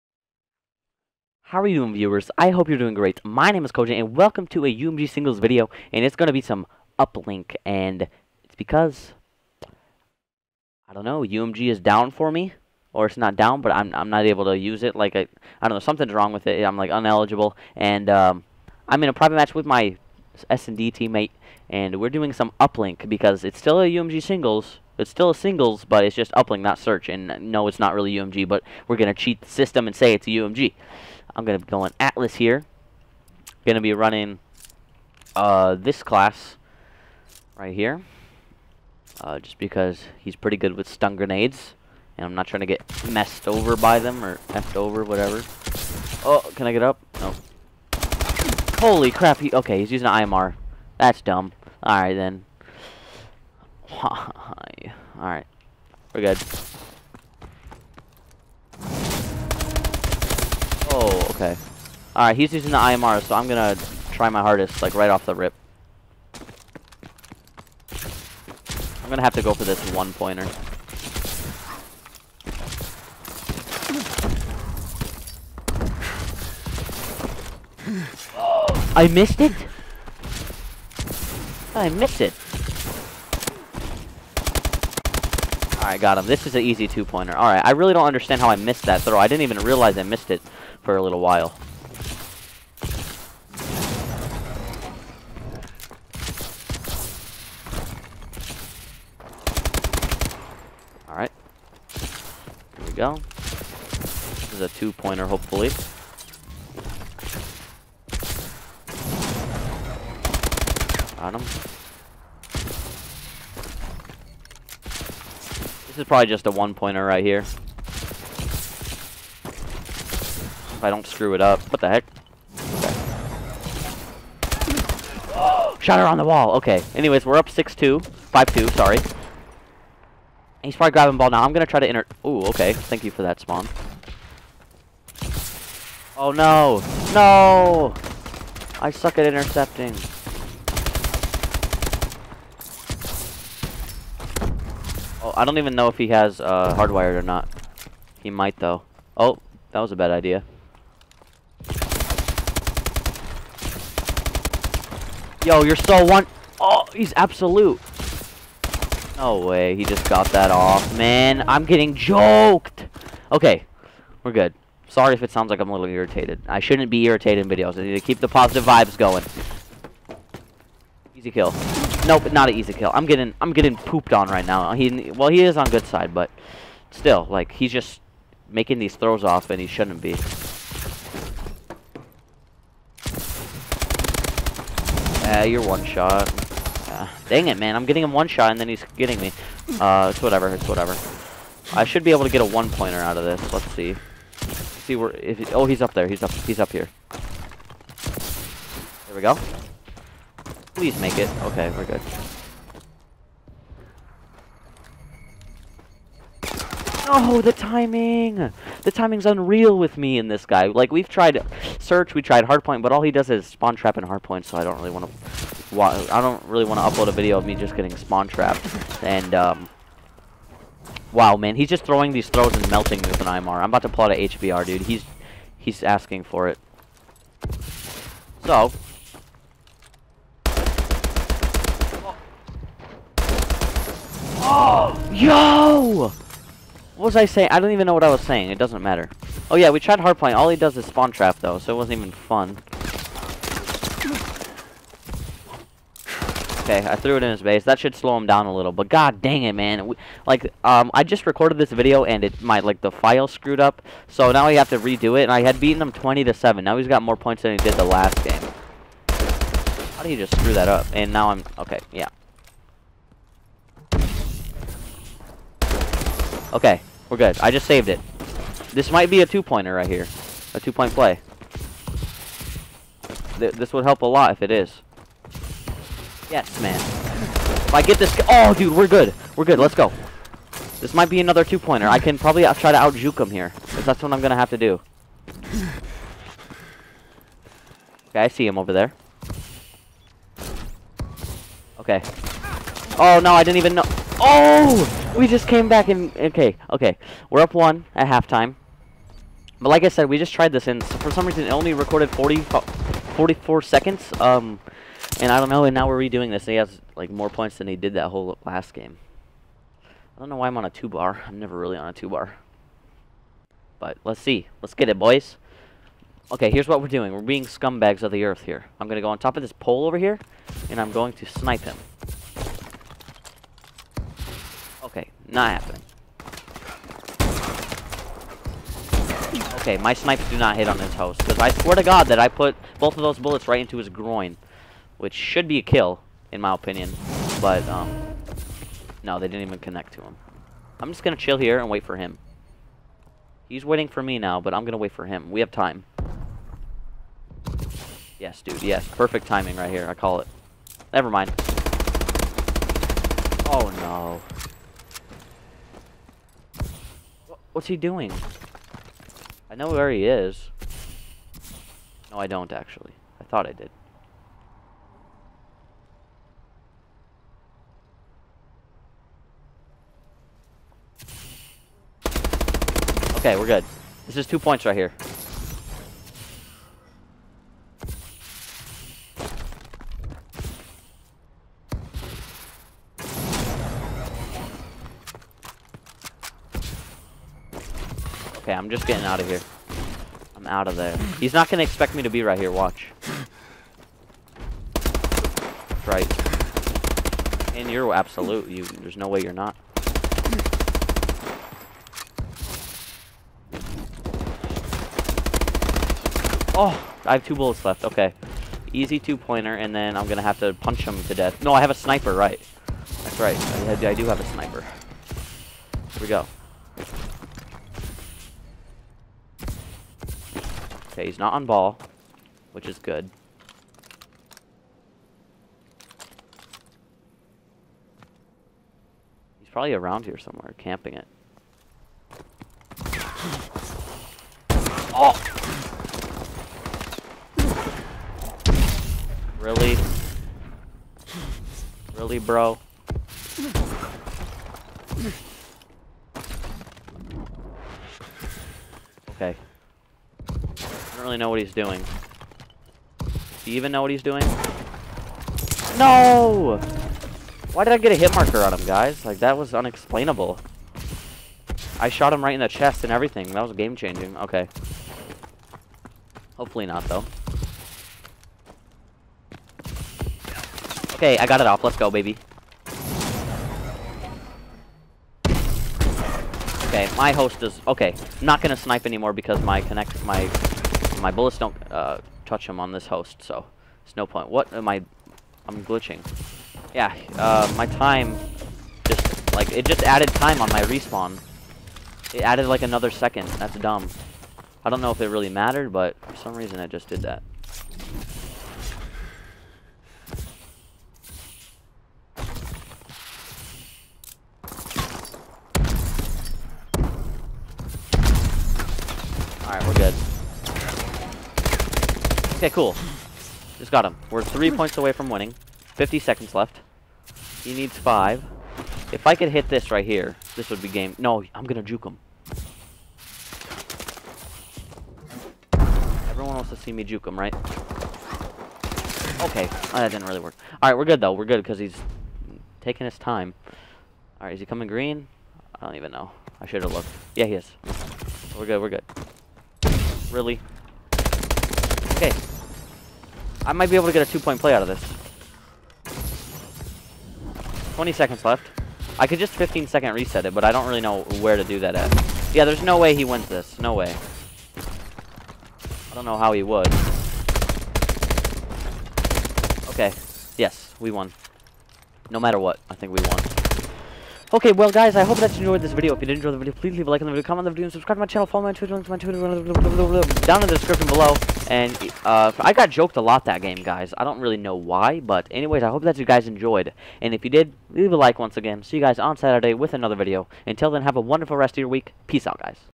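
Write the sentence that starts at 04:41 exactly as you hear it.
I can probably uh, try to out-juke him here.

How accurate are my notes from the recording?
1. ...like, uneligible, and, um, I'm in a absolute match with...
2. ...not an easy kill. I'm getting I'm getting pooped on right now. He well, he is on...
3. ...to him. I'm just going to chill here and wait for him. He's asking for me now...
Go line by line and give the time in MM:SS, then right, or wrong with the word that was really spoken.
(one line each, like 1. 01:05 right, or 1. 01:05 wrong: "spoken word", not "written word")
1. 00:16 wrong: "private", not "absolute"
2. 02:52 right
3. 05:39 wrong: "waiting", not "asking".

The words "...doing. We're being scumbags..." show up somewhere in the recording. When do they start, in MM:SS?
05:16.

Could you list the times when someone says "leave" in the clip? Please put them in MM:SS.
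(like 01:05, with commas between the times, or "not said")
09:26, 09:37.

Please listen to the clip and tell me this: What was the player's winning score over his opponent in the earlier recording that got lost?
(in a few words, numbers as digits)
20 to 7.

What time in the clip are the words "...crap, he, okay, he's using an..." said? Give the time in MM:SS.
00:49.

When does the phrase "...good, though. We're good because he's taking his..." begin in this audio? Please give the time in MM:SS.
08:50.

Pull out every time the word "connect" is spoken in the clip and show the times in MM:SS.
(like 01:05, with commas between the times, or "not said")
05:39, 07:59.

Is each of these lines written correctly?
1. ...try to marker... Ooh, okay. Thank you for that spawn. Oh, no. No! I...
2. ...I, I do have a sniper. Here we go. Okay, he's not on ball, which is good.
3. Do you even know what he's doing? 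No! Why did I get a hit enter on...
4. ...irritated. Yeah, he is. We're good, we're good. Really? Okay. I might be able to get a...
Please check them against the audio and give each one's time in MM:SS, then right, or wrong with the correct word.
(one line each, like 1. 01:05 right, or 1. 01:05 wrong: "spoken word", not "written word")
1. 02:11 wrong: "enter", not "marker"
2. 06:53 right
3. 07:33 wrong: "marker", not "enter"
4. 08:56 wrong: "looked", not "irritated".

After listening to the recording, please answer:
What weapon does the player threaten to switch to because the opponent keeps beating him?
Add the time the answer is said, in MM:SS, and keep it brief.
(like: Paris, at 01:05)
HBR, at 03:44.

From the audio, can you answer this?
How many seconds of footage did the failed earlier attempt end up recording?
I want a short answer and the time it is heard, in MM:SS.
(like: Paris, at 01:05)
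44 seconds, at 05:02.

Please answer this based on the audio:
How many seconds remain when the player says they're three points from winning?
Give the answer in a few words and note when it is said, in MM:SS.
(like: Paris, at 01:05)
50 seconds, at 08:35.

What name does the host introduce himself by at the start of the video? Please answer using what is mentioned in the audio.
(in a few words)
Cogent.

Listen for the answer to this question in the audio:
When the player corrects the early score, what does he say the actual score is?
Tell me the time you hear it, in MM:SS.
02:08.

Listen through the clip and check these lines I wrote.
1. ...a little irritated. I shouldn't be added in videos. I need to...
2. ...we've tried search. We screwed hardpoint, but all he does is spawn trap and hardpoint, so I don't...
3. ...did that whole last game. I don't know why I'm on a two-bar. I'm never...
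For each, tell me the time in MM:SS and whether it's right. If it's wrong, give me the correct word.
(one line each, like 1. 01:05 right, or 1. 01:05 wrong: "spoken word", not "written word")
1. 02:45 wrong: "irritated", not "added"
2. 03:30 wrong: "tried", not "screwed"
3. 05:07 right.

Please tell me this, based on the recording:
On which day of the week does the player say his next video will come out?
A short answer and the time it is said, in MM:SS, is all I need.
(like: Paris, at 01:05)
Saturday, at 09:39.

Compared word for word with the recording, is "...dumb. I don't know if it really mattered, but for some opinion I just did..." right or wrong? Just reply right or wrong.
wrong.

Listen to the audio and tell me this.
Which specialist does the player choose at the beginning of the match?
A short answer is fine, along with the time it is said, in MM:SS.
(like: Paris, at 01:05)
Atlas, at 00:31.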